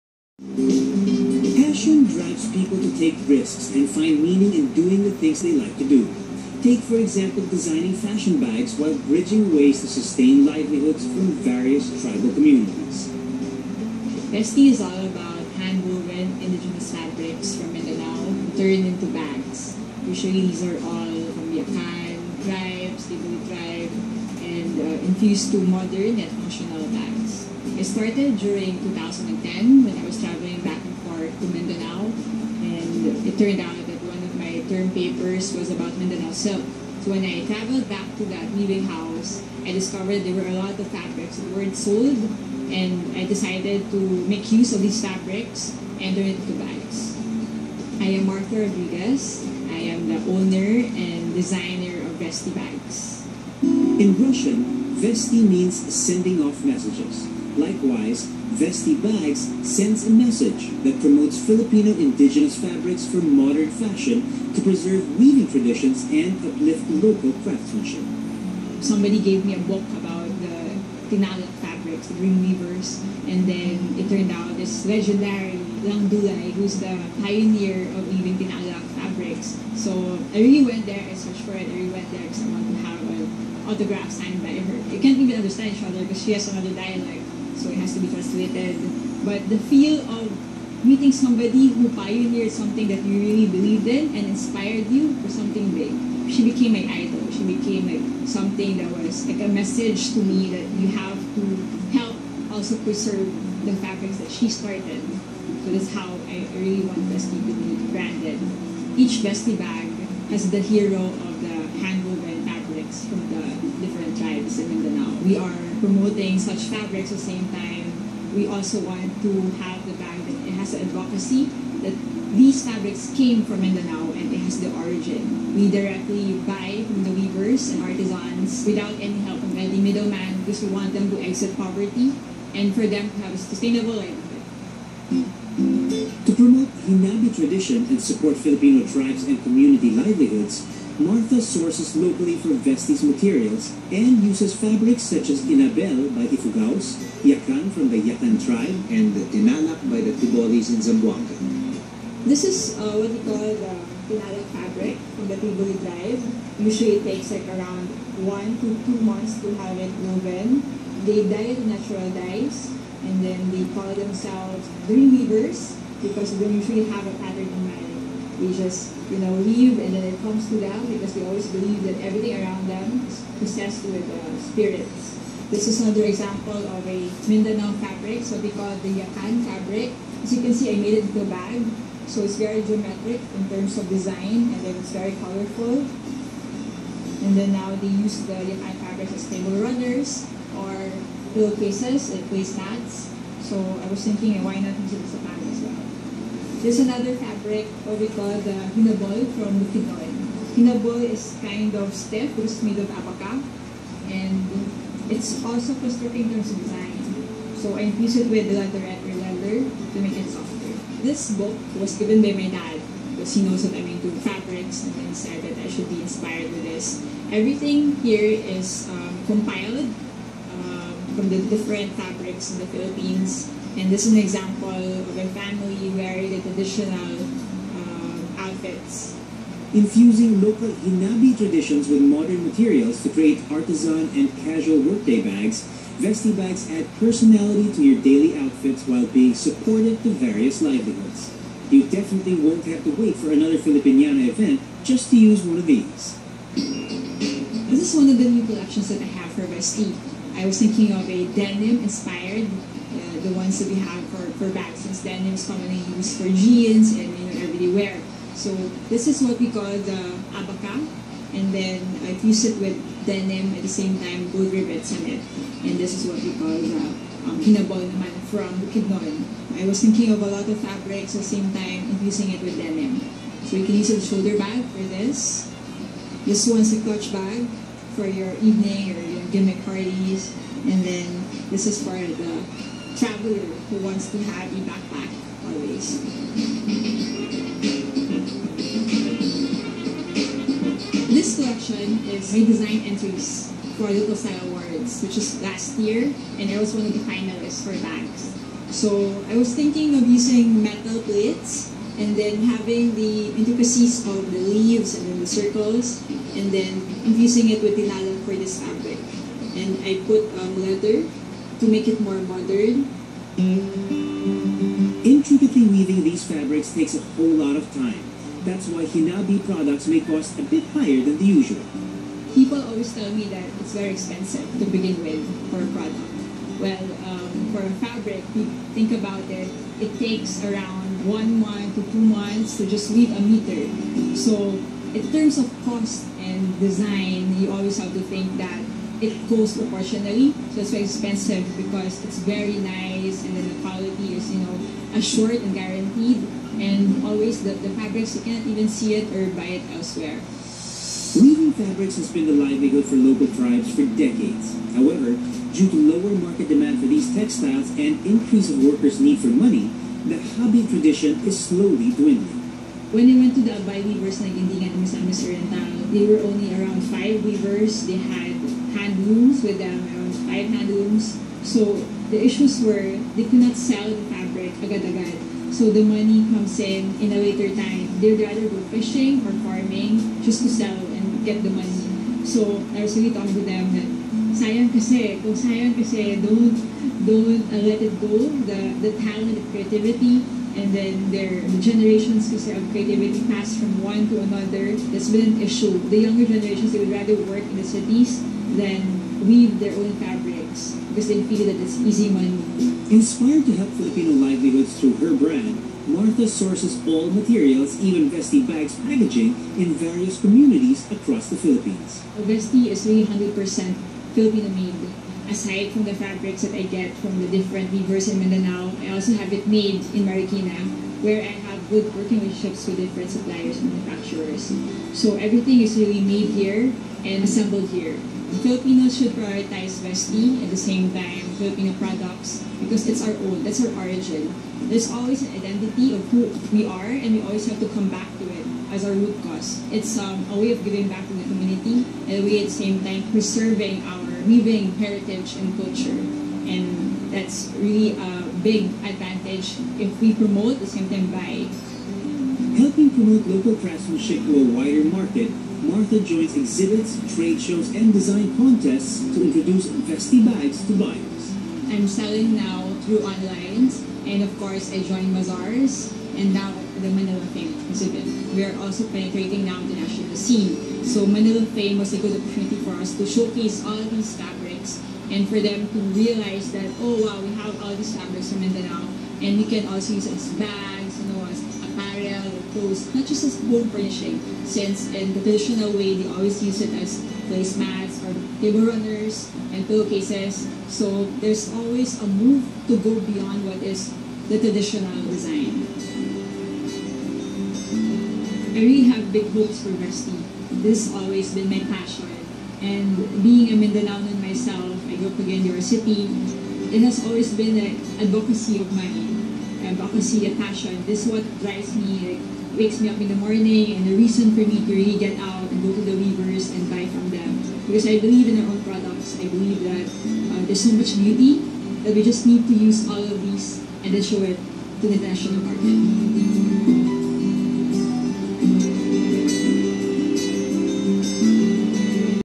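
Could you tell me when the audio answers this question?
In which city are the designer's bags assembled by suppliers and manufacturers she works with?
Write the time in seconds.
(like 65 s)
420 s.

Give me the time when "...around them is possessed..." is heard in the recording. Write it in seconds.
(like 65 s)
172 s.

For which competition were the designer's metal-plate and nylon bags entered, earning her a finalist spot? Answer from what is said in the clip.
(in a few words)
Little Style Awards.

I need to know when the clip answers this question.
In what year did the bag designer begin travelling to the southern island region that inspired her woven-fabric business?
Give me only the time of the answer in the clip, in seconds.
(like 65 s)
28 s.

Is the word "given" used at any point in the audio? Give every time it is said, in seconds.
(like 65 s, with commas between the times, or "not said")
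211 s.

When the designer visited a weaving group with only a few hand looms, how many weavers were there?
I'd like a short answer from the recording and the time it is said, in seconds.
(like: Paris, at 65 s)
5, at 366 s.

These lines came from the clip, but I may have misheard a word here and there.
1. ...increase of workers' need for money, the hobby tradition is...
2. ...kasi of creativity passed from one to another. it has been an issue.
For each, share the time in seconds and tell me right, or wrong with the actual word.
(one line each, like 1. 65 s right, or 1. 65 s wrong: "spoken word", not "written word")
1. 358 s right
2. 392 s right.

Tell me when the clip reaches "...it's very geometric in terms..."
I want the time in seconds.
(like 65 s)
182 s.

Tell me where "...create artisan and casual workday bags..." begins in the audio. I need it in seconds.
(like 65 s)
233 s.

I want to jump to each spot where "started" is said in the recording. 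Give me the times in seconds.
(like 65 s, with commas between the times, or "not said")
27 s, 104 s.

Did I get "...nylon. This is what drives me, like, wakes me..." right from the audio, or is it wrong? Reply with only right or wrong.
wrong.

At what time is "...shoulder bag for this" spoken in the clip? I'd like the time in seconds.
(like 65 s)
273 s.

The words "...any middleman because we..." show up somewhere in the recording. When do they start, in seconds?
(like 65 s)
129 s.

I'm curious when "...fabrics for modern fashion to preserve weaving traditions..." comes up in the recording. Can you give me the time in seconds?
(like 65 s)
62 s.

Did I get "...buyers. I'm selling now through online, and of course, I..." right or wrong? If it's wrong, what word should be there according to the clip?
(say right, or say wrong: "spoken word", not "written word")
right.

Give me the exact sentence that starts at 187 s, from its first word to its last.
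And then now they use the Yakan fabric as table runners or pillowcases and place mats.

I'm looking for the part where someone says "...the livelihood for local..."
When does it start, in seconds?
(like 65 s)
352 s.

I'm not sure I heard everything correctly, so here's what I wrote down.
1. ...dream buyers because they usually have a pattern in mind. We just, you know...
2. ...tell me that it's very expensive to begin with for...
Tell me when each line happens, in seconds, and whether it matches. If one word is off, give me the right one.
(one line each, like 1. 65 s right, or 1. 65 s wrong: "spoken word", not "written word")
1. 164 s wrong: "weavers", not "buyers"
2. 322 s right.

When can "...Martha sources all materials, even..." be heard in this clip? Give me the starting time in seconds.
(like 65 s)
405 s.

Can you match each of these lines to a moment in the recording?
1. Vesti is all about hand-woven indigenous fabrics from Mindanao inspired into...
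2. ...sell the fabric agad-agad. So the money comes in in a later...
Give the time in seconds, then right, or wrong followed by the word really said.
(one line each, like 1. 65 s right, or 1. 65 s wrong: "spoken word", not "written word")
1. 14 s wrong: "turned", not "inspired"
2. 373 s right.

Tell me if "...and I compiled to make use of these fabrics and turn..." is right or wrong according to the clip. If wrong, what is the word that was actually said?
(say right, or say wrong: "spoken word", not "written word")
wrong: "decided", not "compiled".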